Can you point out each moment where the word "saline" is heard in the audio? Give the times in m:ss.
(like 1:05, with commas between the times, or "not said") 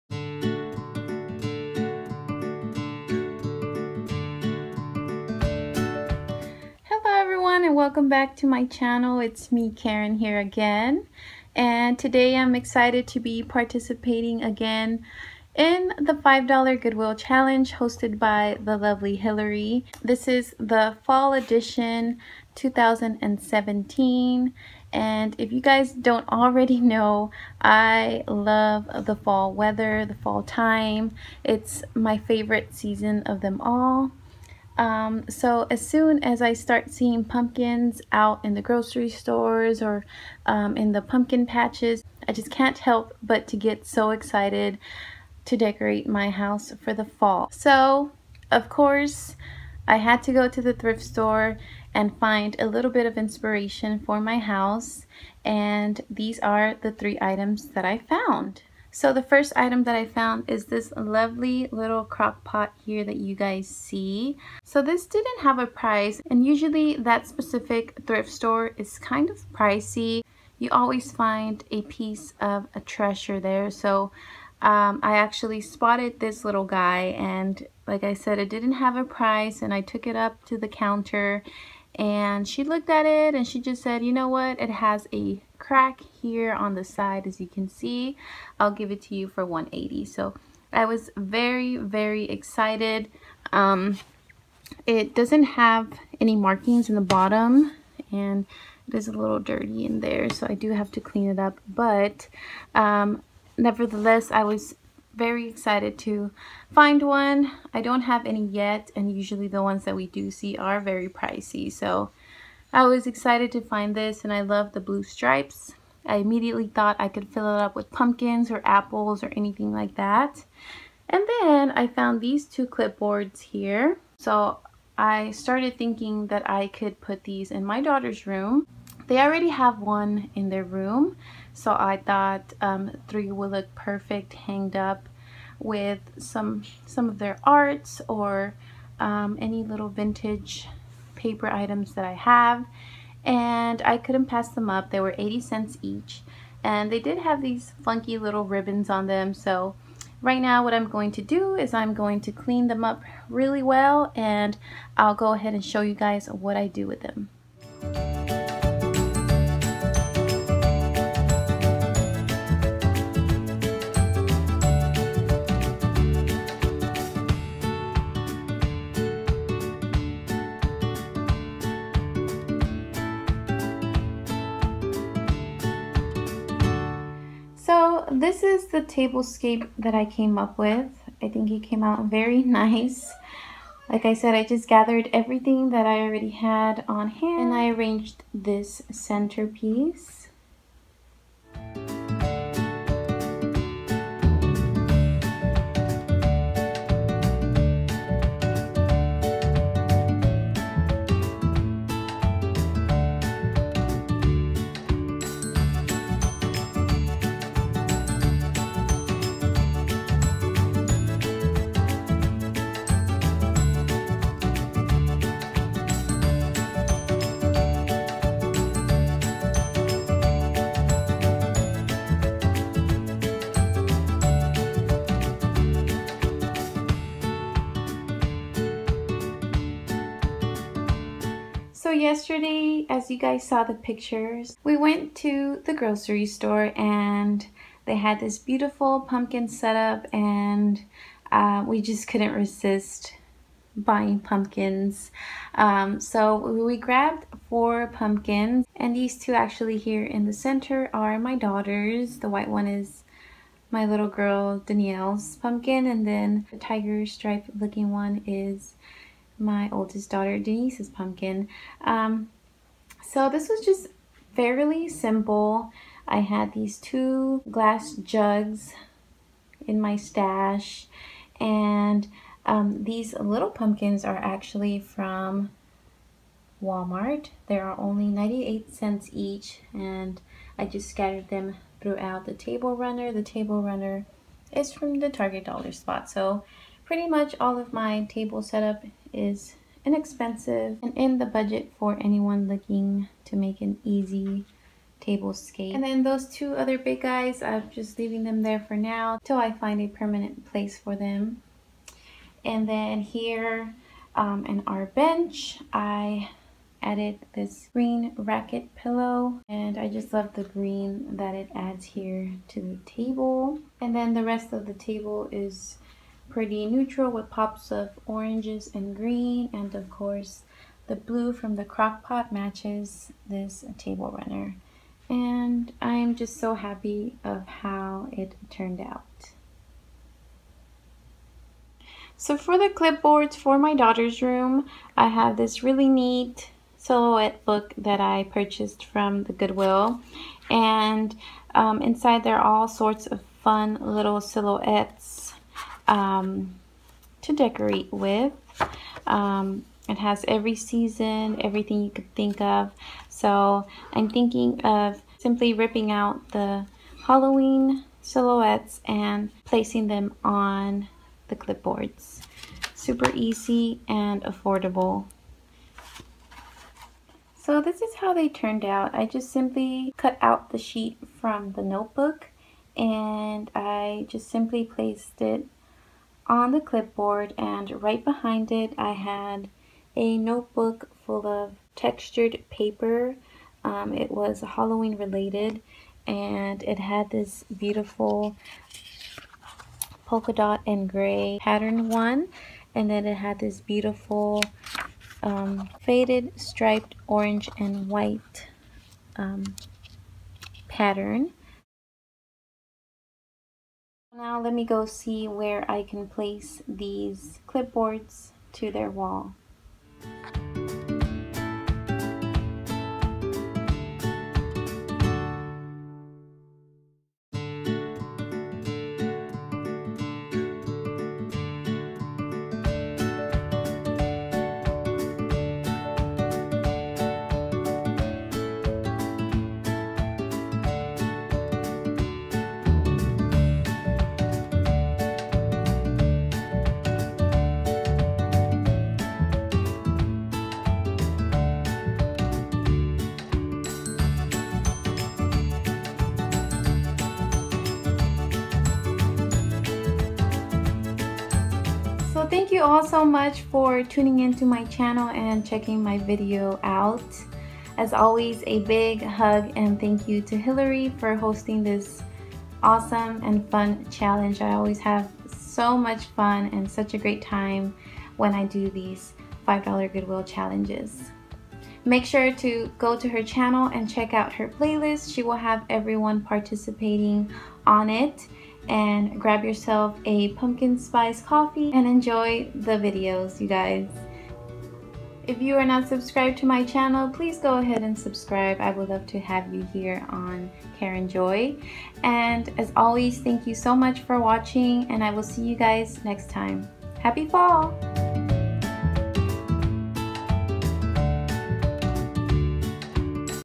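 not said.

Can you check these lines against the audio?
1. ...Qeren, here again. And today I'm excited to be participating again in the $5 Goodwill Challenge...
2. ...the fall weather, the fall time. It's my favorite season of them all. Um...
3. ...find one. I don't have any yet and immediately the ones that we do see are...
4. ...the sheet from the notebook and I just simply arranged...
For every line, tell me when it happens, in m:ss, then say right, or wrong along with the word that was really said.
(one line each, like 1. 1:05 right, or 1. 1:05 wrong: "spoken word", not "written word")
1. 0:09 right
2. 0:29 right
3. 1:46 wrong: "usually", not "immediately"
4. 6:10 wrong: "placed", not "arranged".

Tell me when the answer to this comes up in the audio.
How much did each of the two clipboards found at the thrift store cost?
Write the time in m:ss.
2:25.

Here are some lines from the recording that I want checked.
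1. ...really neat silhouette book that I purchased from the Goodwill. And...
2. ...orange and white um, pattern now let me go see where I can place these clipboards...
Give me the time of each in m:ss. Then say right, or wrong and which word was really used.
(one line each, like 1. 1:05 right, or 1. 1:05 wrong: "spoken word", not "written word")
1. 5:35 right
2. 6:37 right.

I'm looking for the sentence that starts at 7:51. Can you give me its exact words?
Make sure to go to her channel and check out her playlist.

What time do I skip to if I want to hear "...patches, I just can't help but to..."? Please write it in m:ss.
0:41.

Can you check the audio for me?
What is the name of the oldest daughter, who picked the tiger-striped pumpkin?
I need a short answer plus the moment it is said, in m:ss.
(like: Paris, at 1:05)
Denise, at 4:20.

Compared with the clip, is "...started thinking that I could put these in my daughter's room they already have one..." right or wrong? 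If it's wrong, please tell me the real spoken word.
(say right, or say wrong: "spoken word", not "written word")
right.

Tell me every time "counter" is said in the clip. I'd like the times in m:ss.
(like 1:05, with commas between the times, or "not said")
1:20.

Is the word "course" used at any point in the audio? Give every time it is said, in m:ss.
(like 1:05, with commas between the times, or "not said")
0:48, 5:19.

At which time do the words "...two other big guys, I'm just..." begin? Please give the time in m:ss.
4:56.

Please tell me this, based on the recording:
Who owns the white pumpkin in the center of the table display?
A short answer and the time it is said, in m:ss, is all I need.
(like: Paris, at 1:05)
Danielle, at 4:14.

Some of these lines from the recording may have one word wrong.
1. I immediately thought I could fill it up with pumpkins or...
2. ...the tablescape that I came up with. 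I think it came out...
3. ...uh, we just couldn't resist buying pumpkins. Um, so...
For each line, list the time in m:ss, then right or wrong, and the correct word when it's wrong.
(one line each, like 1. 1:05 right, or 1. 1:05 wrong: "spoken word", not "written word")
1. 1:56 right
2. 2:58 right
3. 4:01 right.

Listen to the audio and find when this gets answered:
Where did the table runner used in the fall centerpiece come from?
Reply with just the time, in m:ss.
4:45.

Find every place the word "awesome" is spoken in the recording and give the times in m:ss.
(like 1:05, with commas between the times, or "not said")
7:42.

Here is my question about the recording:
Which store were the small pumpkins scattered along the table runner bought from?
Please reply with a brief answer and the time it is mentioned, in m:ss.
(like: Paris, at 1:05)
Walmart, at 4:36.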